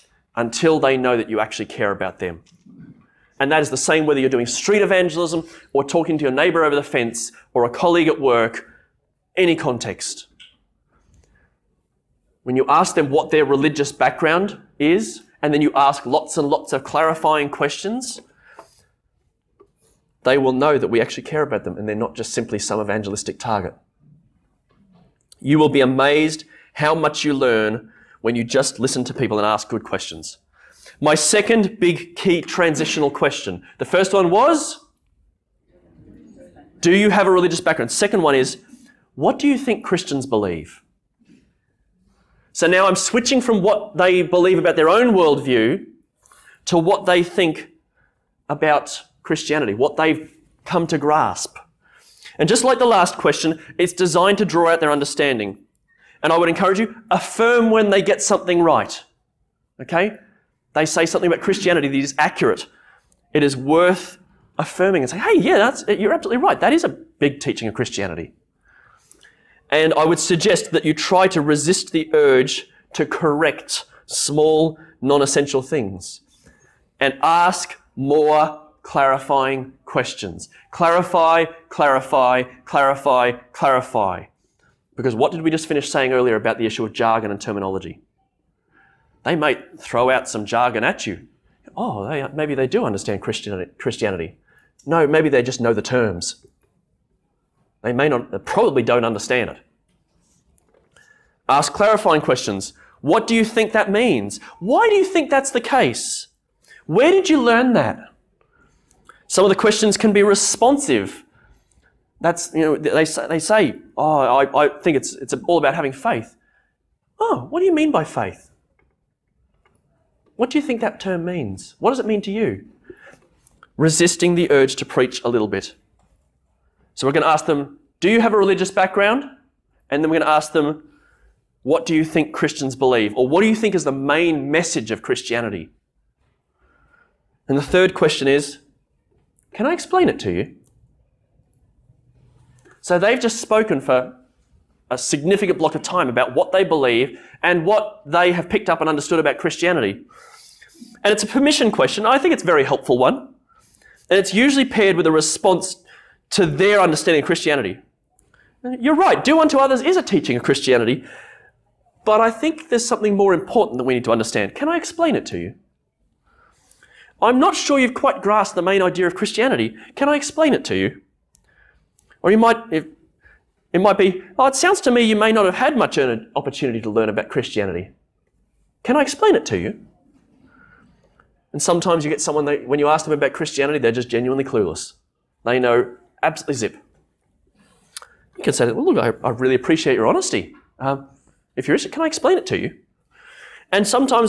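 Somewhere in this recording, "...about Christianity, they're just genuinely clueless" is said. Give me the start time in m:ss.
3:03.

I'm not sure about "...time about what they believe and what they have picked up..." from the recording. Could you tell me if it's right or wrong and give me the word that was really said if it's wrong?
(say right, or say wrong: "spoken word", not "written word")
right.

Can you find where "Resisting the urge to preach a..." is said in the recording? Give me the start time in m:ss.
2:03.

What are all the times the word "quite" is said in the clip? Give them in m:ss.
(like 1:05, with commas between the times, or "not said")
2:47.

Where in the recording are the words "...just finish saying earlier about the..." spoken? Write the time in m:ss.
1:25.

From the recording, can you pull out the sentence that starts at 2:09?
And then we're going to ask them, what do you think Christians believe?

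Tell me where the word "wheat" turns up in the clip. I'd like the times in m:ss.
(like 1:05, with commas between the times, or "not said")
not said.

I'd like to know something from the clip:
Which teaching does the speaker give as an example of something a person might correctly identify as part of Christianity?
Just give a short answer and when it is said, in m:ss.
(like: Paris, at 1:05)
Do unto others, at 2:39.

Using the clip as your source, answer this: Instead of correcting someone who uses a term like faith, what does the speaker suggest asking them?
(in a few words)
What do you mean by faith?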